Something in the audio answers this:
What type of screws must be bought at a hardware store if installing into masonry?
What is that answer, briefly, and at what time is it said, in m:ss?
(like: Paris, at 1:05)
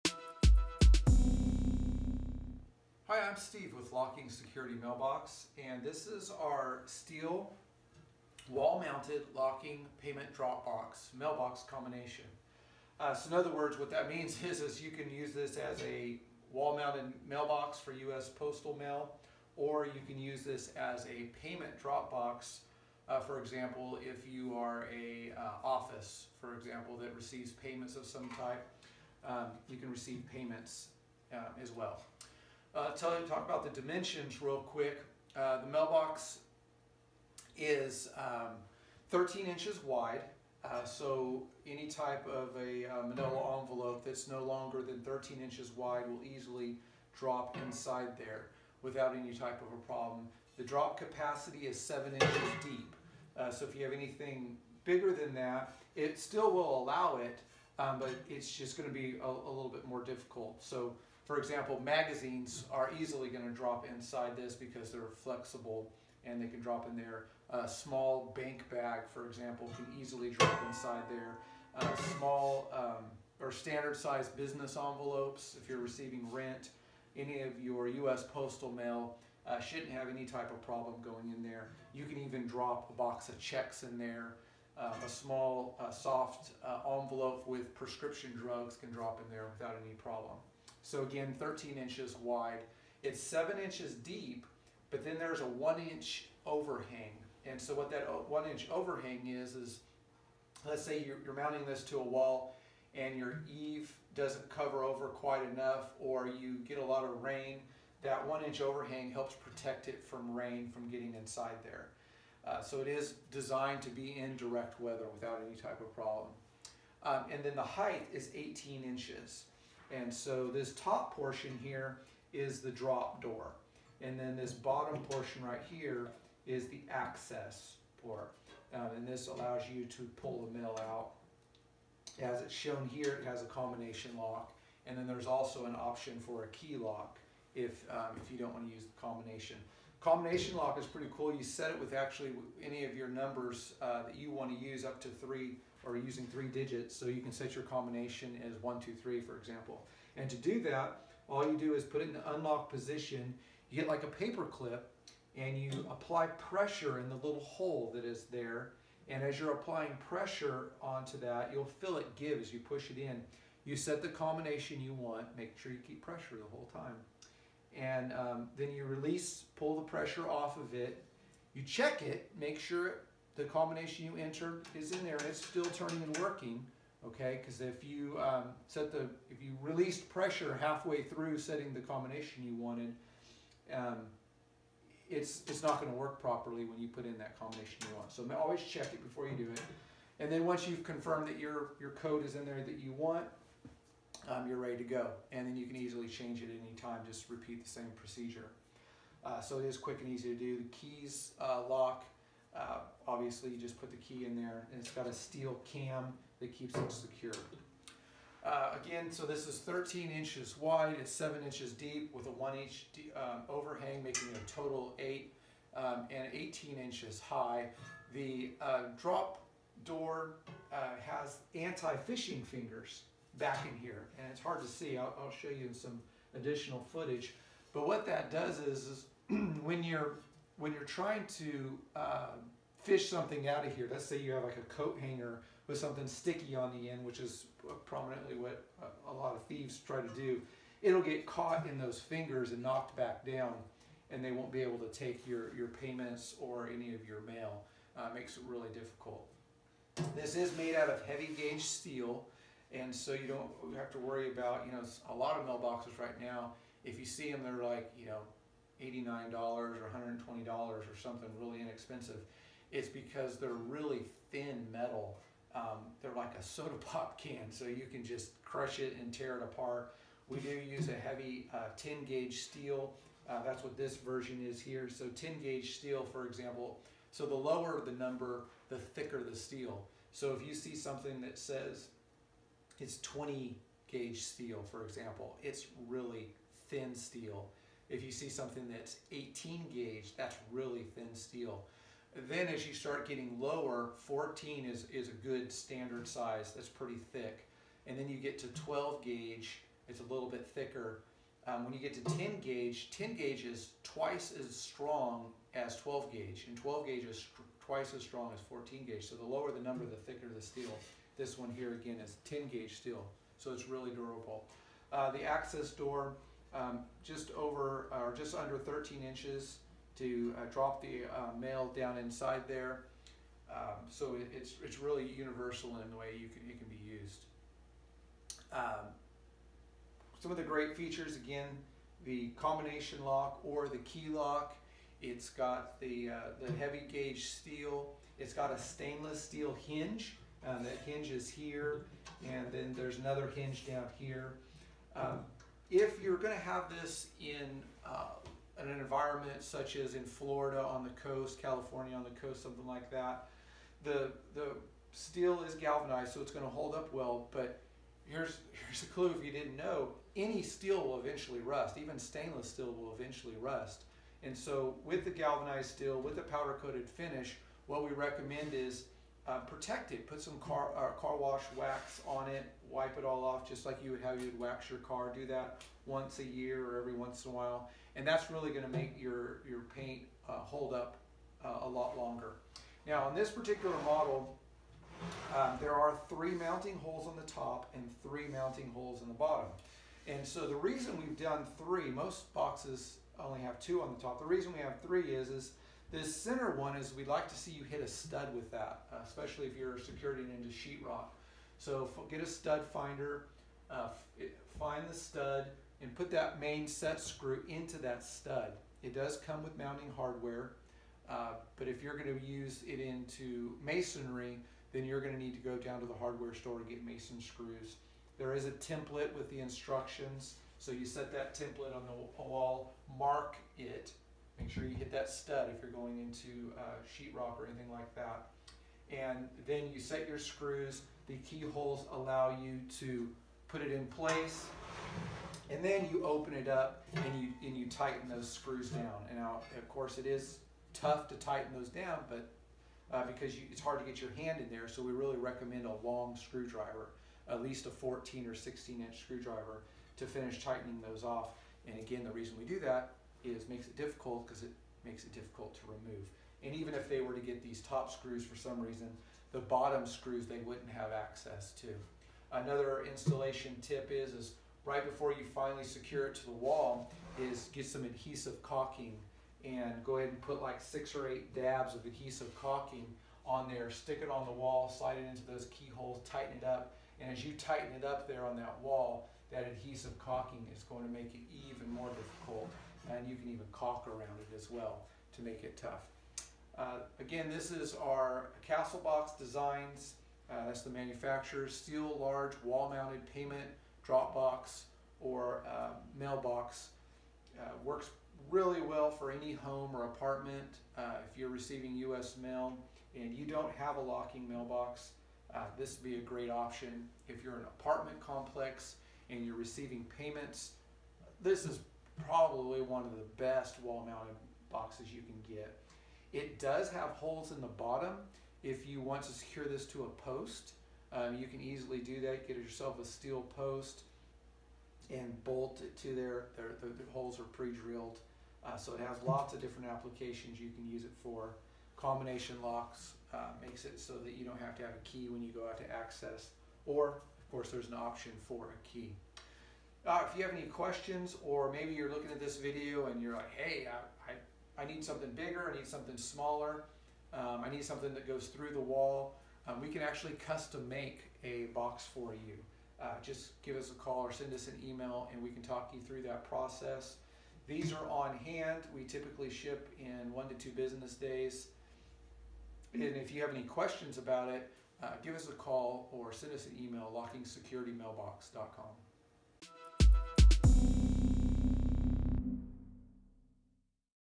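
mason screws, at 6:56.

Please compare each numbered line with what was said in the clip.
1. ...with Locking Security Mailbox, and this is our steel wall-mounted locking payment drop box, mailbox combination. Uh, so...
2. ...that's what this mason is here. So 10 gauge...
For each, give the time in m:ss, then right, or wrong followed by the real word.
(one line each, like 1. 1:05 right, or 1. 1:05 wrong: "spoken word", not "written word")
1. 0:03 right
2. 4:33 wrong: "version", not "mason".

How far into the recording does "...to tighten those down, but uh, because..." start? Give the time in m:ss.
7:21.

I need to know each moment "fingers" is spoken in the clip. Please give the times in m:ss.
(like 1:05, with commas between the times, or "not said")
3:42, 4:01.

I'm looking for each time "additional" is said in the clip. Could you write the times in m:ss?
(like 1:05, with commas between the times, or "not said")
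3:46.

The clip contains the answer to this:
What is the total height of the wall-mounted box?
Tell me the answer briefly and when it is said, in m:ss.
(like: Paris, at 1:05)
18 inches, at 1:57.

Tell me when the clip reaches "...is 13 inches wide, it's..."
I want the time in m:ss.
3:29.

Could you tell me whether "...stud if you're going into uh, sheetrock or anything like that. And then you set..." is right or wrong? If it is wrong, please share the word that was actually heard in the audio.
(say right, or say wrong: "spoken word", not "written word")
right.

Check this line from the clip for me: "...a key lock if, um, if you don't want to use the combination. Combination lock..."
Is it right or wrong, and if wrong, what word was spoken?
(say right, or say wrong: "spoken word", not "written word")
right.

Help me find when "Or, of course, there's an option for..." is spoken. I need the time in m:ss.
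8:56.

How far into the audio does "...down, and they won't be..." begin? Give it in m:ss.
4:03.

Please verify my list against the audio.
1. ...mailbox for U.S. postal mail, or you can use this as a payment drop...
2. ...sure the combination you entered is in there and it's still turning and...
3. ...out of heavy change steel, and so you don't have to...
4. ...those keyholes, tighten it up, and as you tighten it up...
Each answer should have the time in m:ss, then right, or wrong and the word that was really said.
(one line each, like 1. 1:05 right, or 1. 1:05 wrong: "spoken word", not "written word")
1. 0:17 right
2. 2:52 right
3. 4:10 wrong: "gauge", not "change"
4. 7:55 right.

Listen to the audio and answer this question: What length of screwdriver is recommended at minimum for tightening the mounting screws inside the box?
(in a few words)
14 or 16 inch.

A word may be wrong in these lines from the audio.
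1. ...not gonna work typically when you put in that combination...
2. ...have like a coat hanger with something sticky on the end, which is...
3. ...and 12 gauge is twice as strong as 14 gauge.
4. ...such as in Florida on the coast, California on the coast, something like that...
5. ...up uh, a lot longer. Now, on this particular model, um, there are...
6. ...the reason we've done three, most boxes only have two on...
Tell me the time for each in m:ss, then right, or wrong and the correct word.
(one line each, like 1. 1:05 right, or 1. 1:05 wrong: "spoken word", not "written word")
1. 3:05 wrong: "properly", not "typically"
2. 3:54 right
3. 5:06 right
4. 5:49 right
5. 6:20 right
6. 6:30 right.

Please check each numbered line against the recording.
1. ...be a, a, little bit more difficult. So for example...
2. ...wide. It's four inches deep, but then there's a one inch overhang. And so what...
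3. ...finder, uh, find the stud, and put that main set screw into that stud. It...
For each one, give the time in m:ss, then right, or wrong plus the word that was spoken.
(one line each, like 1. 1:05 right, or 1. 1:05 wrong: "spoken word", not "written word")
1. 0:58 right
2. 1:32 wrong: "seven", not "four"
3. 6:42 right.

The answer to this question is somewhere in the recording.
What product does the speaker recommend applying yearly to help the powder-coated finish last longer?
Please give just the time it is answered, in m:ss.
6:10.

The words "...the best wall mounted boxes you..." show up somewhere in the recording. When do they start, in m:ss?
8:32.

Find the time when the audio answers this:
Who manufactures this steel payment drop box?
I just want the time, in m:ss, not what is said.
8:08.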